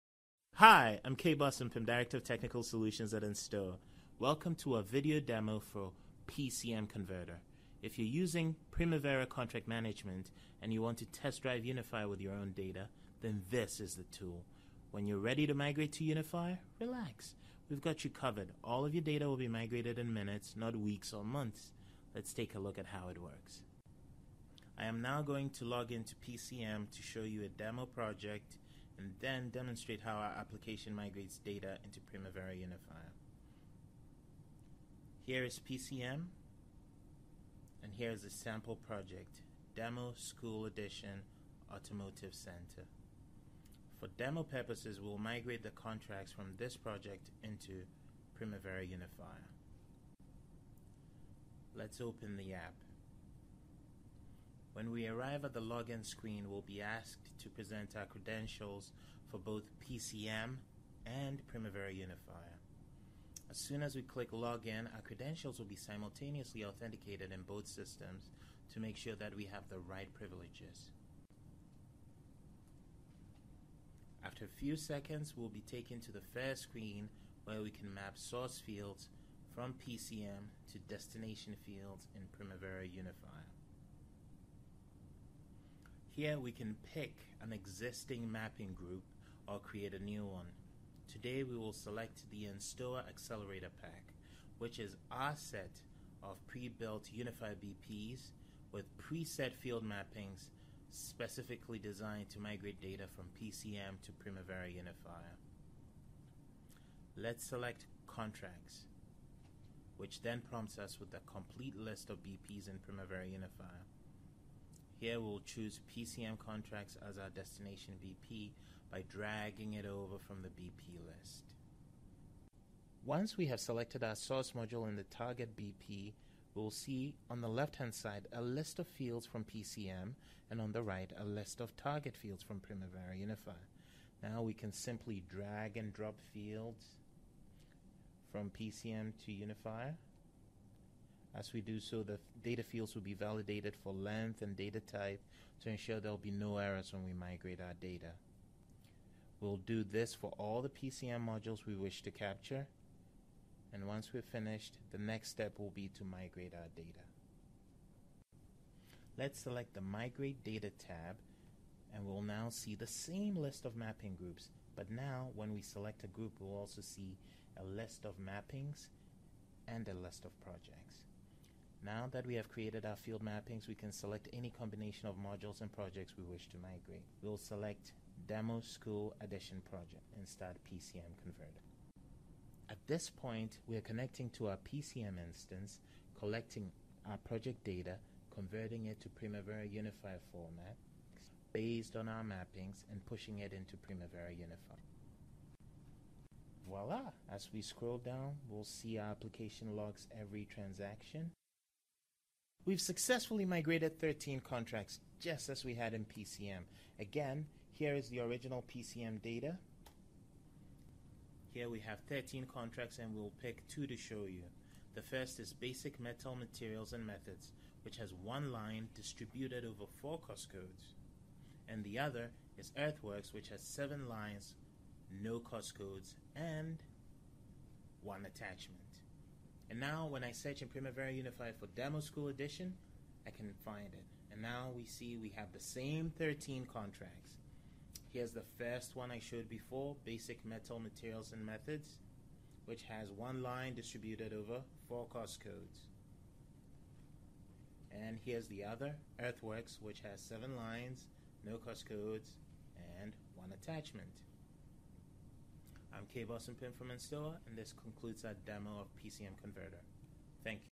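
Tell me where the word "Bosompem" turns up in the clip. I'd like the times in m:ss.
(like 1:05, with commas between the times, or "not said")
0:01, 4:16.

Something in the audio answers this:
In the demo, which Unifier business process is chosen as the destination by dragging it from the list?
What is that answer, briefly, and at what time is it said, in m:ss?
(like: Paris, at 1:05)
PCM contracts, at 1:55.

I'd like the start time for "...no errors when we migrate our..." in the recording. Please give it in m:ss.
2:26.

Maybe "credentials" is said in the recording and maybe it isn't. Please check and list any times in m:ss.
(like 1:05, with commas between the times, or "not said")
0:58, 1:05.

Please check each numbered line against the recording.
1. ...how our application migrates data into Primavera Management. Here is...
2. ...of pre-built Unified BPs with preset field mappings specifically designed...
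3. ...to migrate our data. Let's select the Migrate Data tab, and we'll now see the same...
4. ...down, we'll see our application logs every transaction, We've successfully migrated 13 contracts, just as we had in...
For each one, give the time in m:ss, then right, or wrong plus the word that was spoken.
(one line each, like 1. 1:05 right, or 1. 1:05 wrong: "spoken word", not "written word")
1. 0:30 wrong: "Unifier", not "Management"
2. 1:36 right
3. 2:35 right
4. 3:17 right.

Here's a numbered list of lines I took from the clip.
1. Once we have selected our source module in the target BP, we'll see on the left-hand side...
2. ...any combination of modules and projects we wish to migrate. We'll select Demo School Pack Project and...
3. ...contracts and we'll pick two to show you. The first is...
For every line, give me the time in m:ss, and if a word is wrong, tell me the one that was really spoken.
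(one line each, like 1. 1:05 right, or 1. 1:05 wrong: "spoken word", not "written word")
1. 2:03 right
2. 2:54 wrong: "Addition", not "Pack"
3. 3:32 right.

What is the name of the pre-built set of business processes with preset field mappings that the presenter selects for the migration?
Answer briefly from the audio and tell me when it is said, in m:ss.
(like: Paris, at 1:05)
Enstoa Accelerator Pack, at 1:32.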